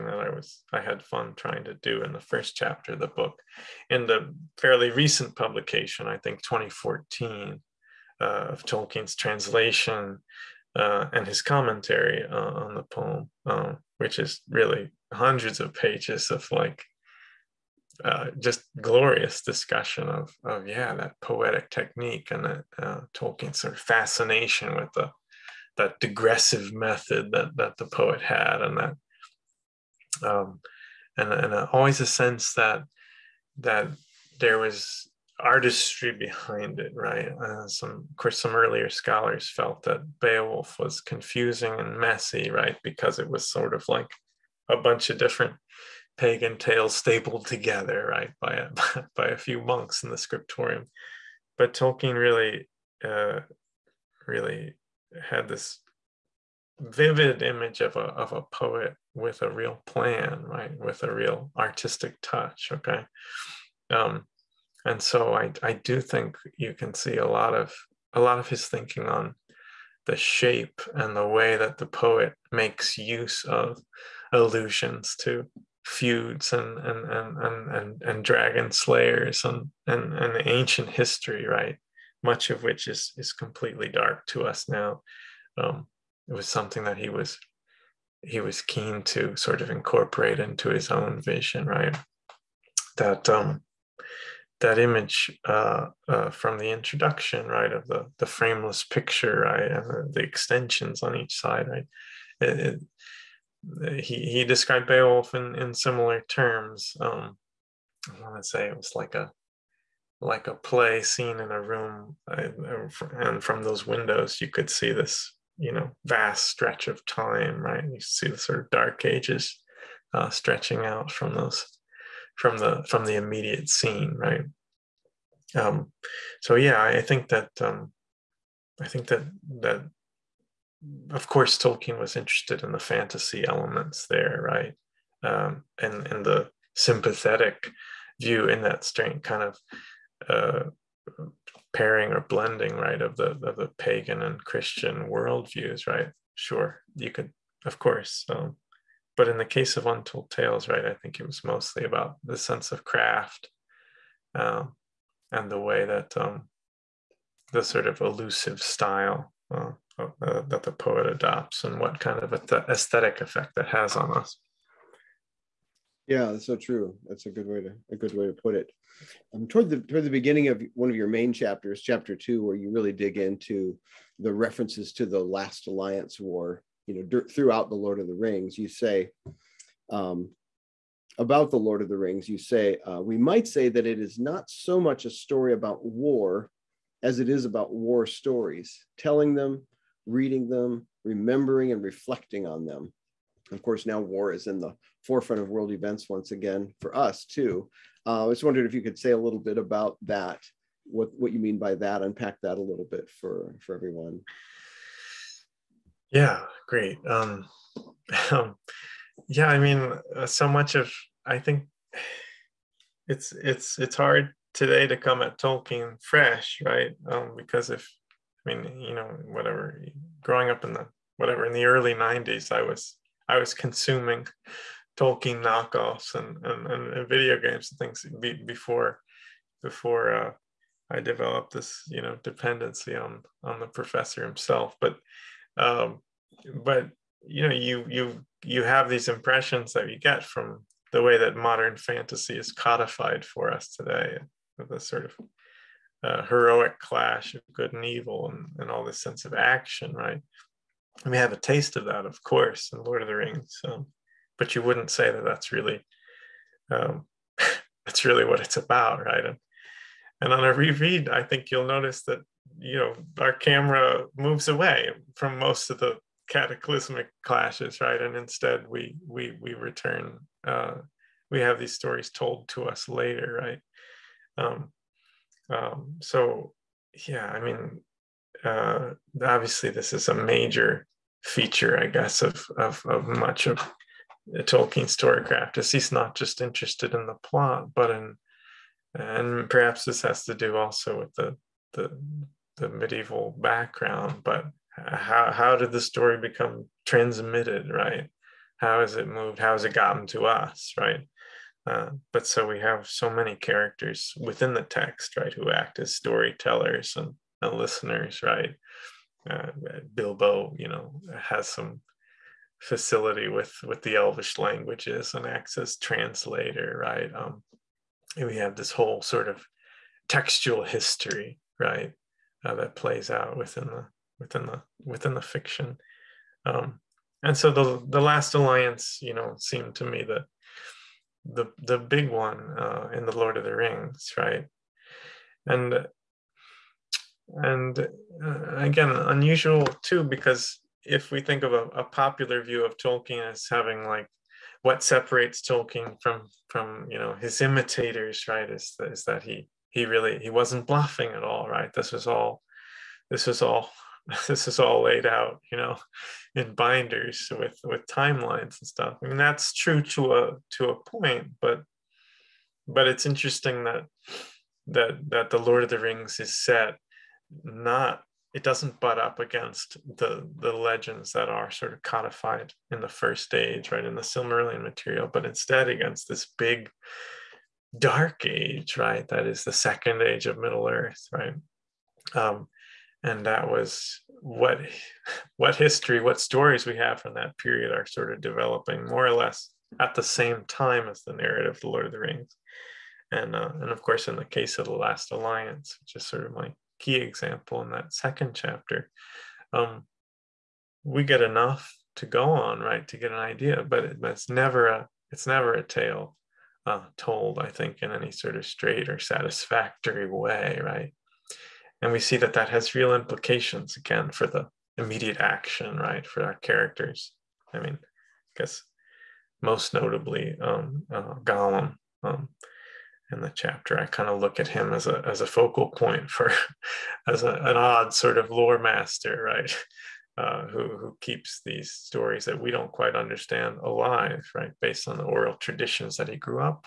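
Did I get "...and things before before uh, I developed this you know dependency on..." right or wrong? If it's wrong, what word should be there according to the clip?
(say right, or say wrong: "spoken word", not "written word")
right.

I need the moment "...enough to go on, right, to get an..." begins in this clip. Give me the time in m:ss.
6:41.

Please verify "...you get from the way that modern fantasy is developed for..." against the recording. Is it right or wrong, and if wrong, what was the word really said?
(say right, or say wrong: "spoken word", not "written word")
wrong: "codified", not "developed".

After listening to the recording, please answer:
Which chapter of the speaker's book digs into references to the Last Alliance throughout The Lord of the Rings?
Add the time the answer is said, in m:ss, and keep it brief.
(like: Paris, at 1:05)
chapter two, at 2:51.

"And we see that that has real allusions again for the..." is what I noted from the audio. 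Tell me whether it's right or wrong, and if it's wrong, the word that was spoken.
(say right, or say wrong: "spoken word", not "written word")
wrong: "implications", not "allusions".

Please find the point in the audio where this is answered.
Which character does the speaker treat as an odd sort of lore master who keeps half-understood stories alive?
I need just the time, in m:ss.
7:01.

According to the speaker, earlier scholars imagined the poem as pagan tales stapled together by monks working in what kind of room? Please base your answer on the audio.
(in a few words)
the scriptorium.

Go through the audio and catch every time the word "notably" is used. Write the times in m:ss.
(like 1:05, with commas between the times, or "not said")
6:59.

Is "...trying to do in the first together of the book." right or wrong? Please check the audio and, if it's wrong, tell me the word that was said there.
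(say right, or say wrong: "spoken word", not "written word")
wrong: "chapter", not "together".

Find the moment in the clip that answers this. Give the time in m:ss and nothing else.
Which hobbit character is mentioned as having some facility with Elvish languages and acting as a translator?
5:09.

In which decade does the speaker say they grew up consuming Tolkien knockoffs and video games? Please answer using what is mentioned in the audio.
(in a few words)
the early 90s.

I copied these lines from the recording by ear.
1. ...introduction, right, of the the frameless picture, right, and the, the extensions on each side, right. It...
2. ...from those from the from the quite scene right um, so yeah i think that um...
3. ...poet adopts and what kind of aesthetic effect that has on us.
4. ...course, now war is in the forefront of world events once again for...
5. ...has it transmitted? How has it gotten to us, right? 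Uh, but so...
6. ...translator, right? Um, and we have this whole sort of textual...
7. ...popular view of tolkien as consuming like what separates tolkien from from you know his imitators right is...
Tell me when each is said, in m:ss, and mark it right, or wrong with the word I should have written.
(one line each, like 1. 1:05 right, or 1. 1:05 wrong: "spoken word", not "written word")
1. 1:36 right
2. 2:01 wrong: "immediate", not "quite"
3. 2:40 right
4. 3:13 right
5. 4:58 wrong: "moved", not "transmitted"
6. 5:15 right
7. 5:41 wrong: "having", not "consuming".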